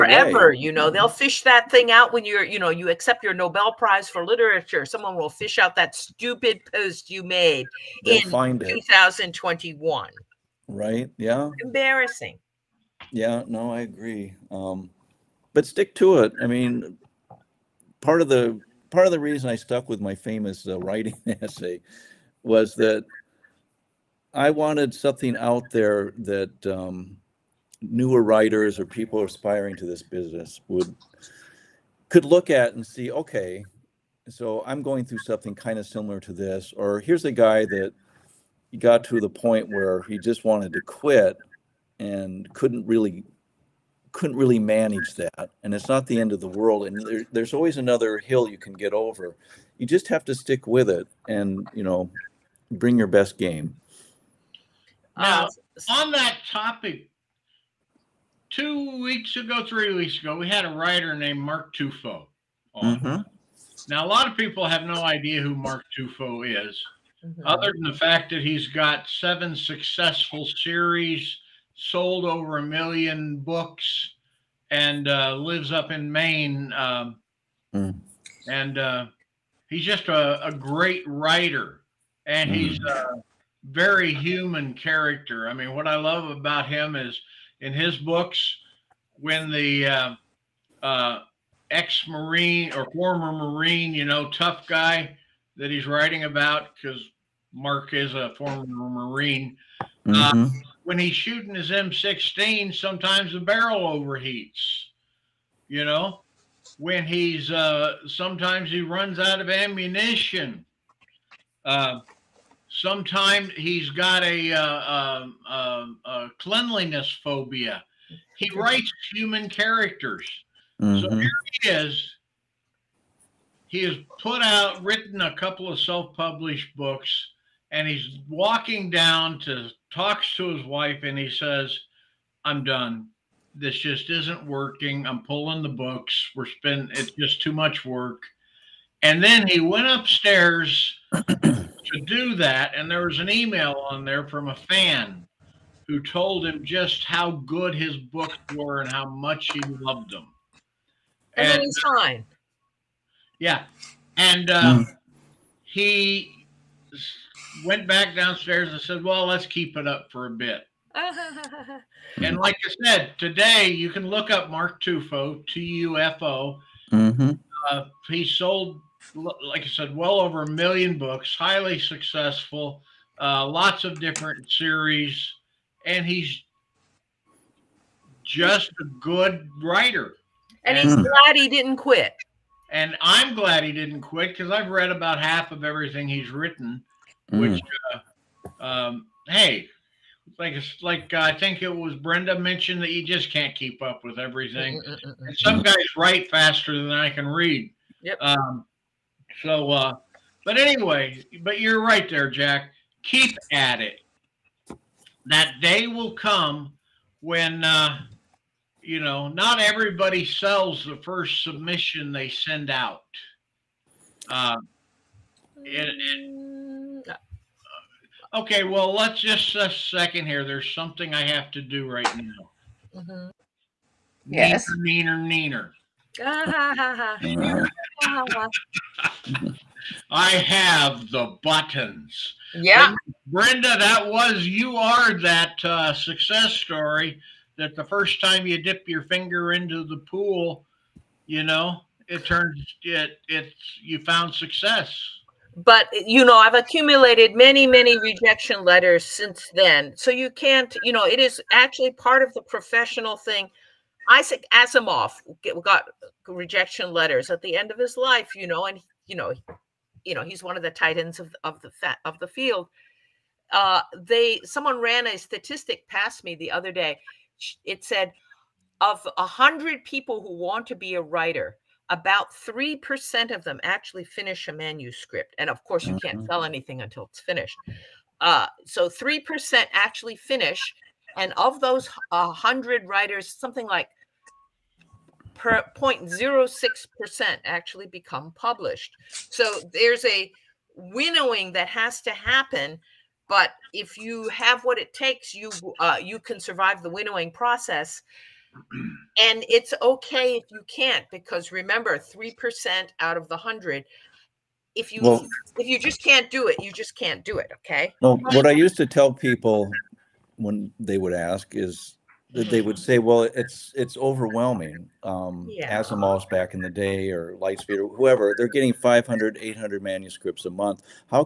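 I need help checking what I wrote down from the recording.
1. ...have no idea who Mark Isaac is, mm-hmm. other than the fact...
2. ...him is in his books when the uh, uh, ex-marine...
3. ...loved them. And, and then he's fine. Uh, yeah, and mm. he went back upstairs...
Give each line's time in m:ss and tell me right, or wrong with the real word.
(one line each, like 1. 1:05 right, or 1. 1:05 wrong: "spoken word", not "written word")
1. 1:04 wrong: "Tufo", not "Isaac"
2. 1:26 right
3. 2:29 wrong: "downstairs", not "upstairs".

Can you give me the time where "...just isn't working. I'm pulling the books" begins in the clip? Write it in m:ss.
2:13.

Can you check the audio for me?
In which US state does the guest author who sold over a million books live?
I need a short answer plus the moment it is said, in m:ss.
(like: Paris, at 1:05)
Maine, at 1:16.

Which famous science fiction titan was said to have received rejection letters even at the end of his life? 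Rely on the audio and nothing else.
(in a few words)
Isaac Asimov.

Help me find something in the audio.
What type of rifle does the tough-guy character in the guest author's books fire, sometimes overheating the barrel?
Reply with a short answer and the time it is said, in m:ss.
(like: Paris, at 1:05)
M16, at 1:41.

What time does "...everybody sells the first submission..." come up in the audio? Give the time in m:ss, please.
3:29.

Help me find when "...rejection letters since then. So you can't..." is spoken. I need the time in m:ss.
4:07.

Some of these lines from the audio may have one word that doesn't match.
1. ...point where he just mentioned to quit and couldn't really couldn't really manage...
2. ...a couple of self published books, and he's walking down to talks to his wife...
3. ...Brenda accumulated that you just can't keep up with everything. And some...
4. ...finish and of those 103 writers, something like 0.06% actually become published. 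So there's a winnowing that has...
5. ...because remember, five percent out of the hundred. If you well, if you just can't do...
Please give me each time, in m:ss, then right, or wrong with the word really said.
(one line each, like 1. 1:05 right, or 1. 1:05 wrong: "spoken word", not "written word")
1. 0:39 wrong: "wanted", not "mentioned"
2. 2:05 right
3. 3:11 wrong: "mentioned", not "accumulated"
4. 4:40 wrong: "100", not "103"
5. 5:01 wrong: "three", not "five".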